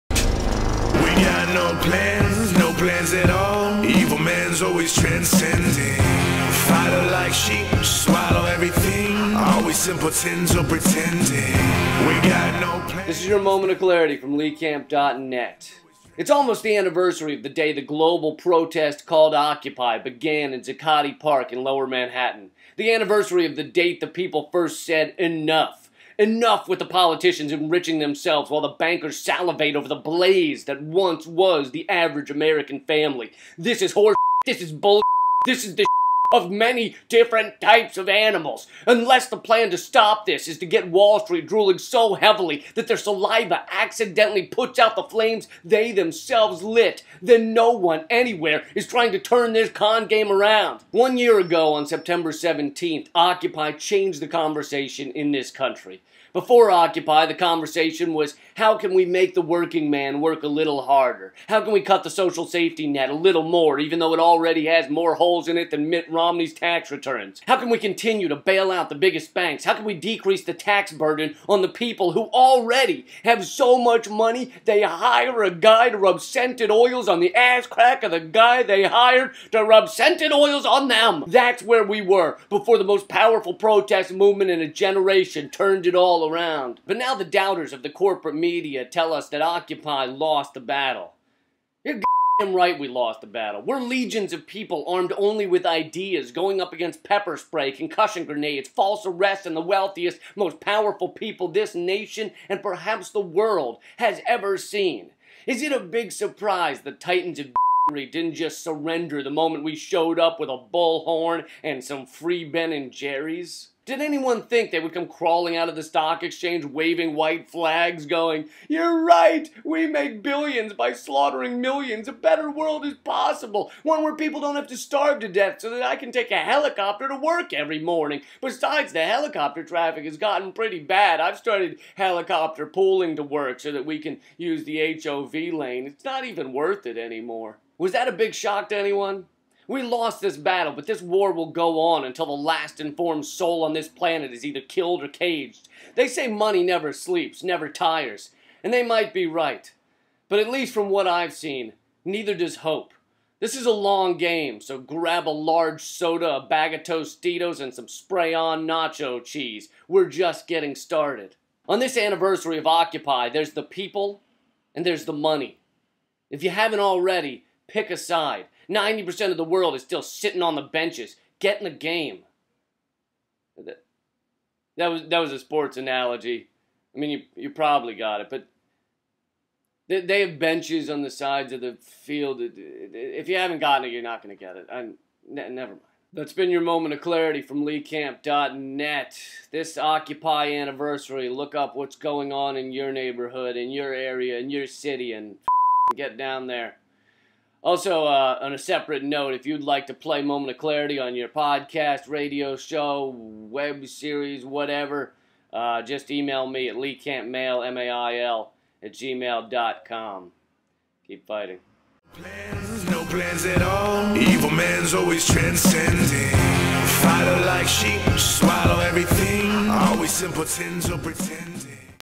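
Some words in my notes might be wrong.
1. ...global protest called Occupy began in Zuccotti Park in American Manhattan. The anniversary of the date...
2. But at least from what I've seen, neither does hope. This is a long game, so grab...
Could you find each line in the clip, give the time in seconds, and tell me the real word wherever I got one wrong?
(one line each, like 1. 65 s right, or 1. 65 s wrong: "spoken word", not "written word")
1. 17 s wrong: "Lower", not "American"
2. 150 s right.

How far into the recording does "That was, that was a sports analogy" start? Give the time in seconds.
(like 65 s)
174 s.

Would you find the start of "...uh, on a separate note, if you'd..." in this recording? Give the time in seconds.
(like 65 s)
198 s.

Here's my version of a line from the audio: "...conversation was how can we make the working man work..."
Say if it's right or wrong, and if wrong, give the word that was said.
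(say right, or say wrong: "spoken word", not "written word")
right.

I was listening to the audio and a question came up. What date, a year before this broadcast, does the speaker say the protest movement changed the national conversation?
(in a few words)
September 17th.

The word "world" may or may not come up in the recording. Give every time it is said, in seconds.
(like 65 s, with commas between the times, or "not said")
103 s, 122 s, 169 s.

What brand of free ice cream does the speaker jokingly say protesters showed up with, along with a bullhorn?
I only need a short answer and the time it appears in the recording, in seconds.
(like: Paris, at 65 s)
Ben and Jerry's, at 112 s.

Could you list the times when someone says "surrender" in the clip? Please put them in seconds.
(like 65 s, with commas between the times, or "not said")
108 s.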